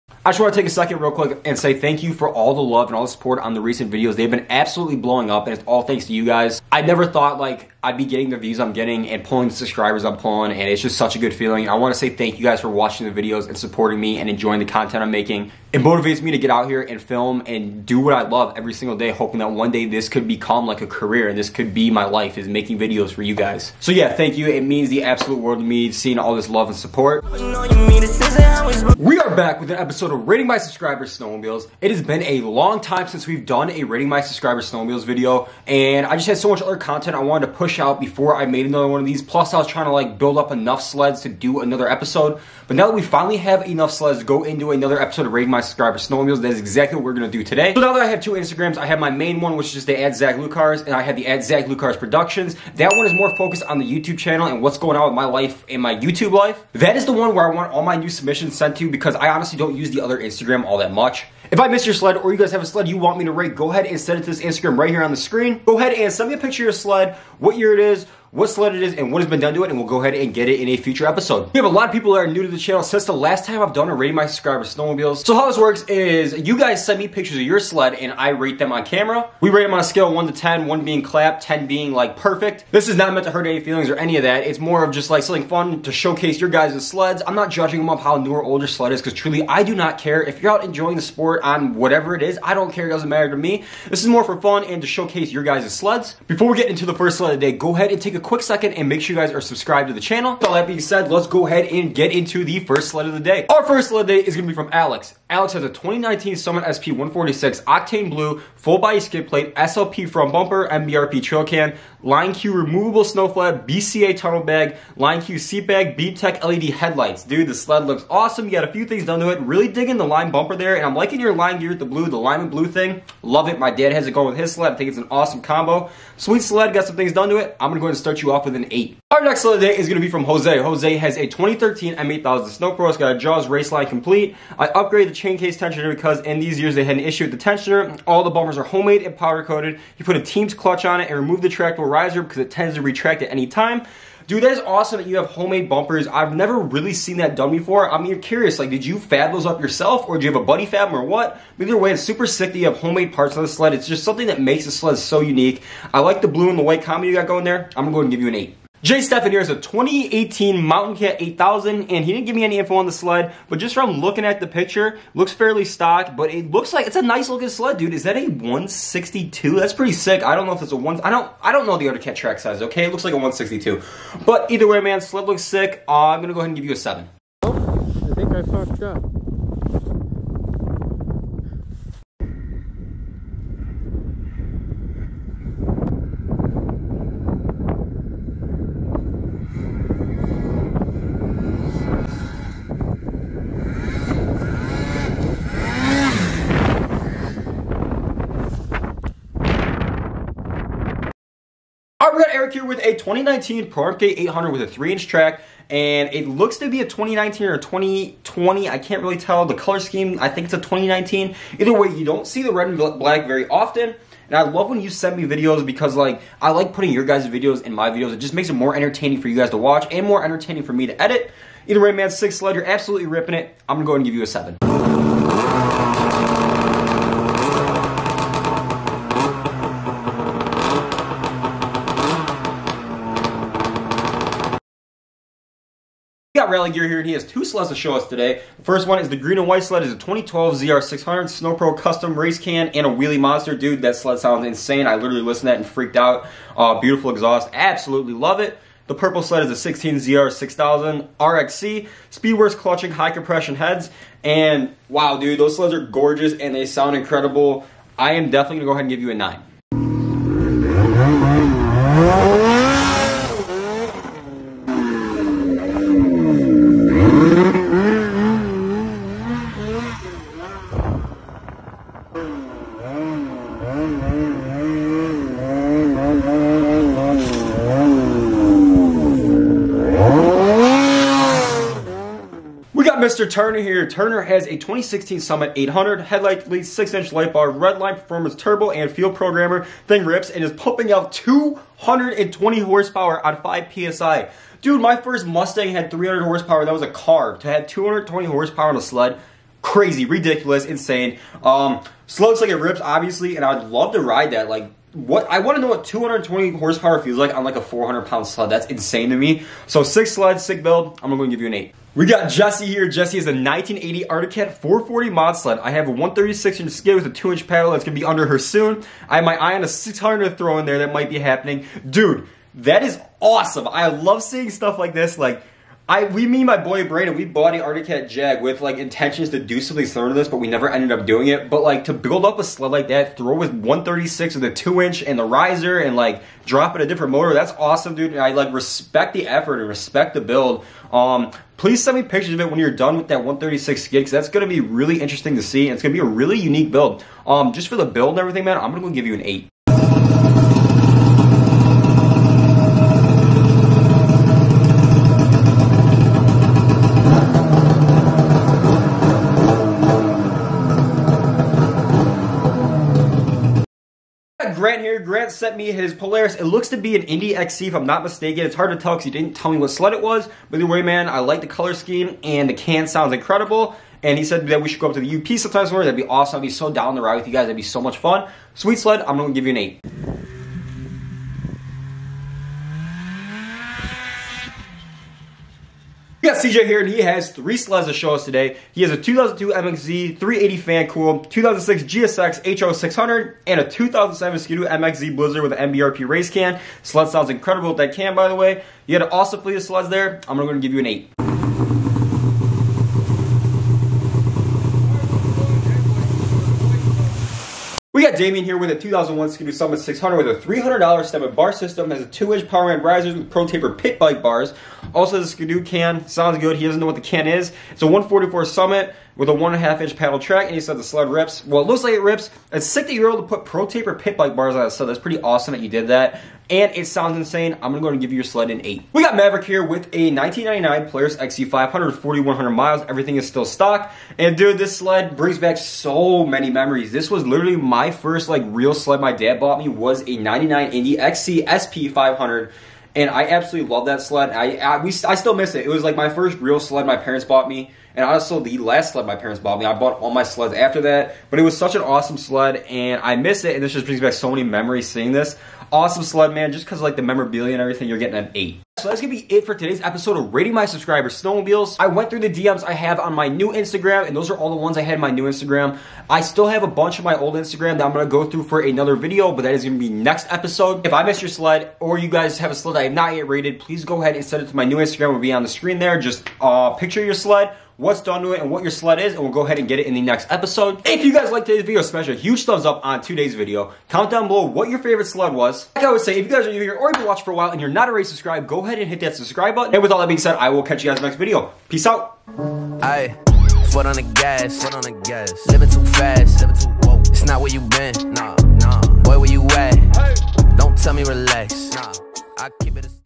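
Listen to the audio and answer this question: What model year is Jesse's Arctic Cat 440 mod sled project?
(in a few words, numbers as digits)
1980.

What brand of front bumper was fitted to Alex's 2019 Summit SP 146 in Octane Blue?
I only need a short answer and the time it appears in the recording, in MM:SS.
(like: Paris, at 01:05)
SLP, at 01:49.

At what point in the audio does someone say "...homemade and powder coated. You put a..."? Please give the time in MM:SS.
02:18.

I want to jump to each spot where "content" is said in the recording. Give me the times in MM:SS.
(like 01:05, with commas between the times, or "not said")
00:14, 00:36.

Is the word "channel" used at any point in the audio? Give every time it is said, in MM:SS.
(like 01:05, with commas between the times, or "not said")
00:54, 01:12, 01:39.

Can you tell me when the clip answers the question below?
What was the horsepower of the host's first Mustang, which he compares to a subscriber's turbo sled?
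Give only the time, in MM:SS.
04:55.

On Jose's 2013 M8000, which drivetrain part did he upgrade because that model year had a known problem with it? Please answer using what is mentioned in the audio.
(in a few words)
chain case tensioner.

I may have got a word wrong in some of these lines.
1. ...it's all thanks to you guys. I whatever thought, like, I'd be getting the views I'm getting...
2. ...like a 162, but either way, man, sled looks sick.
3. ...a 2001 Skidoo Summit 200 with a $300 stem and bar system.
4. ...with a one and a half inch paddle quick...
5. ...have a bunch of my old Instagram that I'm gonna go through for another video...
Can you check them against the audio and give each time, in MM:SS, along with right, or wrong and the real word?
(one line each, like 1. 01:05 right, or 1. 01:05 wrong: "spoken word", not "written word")
1. 00:05 wrong: "never", not "whatever"
2. 02:53 right
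3. 06:48 wrong: "600", not "200"
4. 06:59 wrong: "track", not "quick"
5. 07:46 right.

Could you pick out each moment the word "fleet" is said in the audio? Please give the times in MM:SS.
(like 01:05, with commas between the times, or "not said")
06:39.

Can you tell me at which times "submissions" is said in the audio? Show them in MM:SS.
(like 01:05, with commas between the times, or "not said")
00:58.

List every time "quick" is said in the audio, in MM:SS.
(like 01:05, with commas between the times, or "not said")
00:01, 01:38.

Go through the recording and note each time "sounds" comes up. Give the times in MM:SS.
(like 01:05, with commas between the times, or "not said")
04:04, 04:16, 06:12, 06:37, 06:56, 07:06.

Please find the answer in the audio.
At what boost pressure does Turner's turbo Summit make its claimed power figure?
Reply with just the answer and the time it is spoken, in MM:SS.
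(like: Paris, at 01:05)
5 PSI, at 04:53.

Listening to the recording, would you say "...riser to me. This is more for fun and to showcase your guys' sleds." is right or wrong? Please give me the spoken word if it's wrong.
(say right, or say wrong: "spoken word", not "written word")
wrong: "matter", not "riser".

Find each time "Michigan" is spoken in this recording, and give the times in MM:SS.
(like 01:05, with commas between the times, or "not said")
not said.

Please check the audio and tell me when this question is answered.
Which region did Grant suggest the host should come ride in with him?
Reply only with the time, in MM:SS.
06:14.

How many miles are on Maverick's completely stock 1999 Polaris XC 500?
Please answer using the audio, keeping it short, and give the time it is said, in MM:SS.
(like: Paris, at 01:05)
4100, at 07:11.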